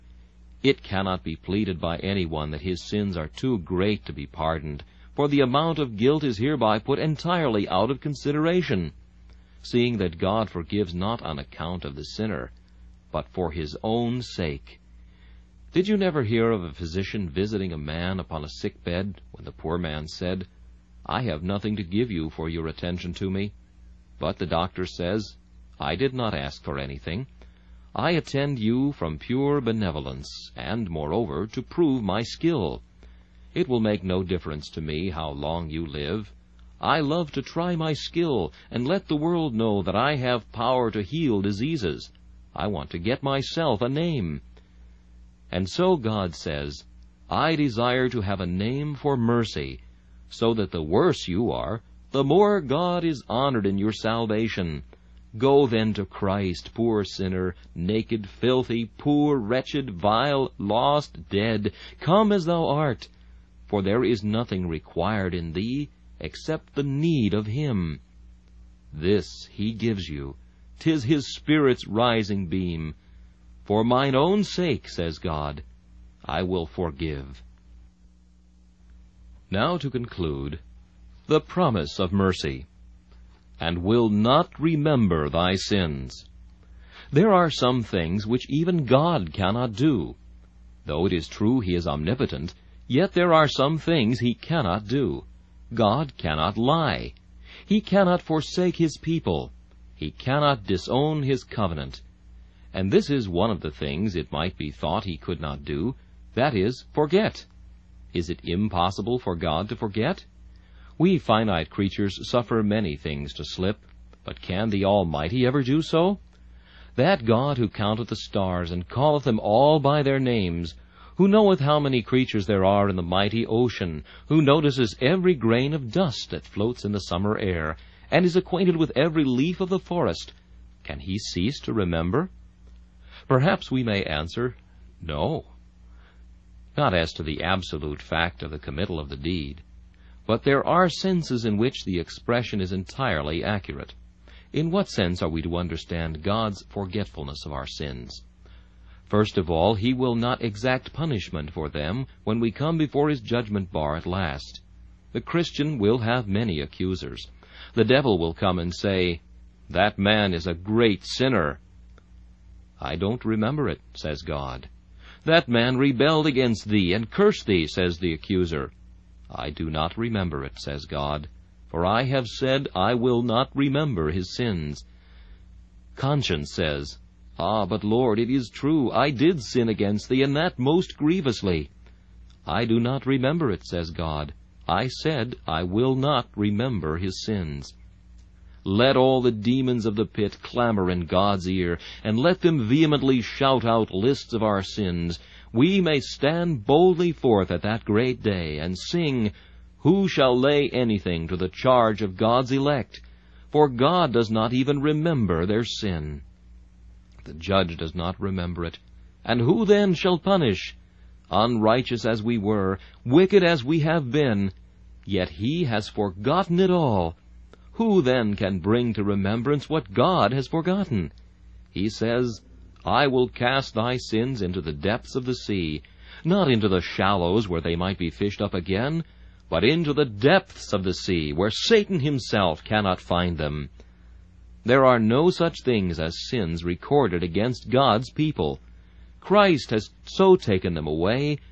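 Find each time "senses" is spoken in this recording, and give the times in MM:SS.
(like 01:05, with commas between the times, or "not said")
02:20, 02:24.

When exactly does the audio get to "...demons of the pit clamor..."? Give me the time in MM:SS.
03:09.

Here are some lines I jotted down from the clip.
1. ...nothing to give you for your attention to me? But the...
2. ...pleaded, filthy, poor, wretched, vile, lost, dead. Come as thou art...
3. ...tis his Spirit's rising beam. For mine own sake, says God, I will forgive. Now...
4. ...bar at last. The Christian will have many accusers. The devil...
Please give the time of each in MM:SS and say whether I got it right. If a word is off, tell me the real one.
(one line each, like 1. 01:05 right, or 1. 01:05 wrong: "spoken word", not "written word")
1. 00:21 right
2. 00:57 wrong: "naked", not "pleaded"
3. 01:10 right
4. 02:33 right.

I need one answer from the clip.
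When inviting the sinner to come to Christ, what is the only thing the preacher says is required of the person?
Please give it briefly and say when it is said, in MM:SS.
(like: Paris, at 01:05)
the need of him, at 01:06.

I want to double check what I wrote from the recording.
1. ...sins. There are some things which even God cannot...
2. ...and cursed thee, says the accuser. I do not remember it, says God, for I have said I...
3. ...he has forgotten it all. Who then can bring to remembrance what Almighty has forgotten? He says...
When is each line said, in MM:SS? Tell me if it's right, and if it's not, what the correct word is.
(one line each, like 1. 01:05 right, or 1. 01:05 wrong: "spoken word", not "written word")
1. 01:25 right
2. 02:46 right
3. 03:35 wrong: "God", not "Almighty".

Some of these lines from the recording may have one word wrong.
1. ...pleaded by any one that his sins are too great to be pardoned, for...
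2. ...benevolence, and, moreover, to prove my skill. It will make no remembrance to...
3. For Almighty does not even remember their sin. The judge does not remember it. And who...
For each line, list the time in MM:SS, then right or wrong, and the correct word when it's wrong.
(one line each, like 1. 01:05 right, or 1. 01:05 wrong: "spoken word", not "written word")
1. 00:01 right
2. 00:29 wrong: "difference", not "remembrance"
3. 03:23 wrong: "God", not "Almighty".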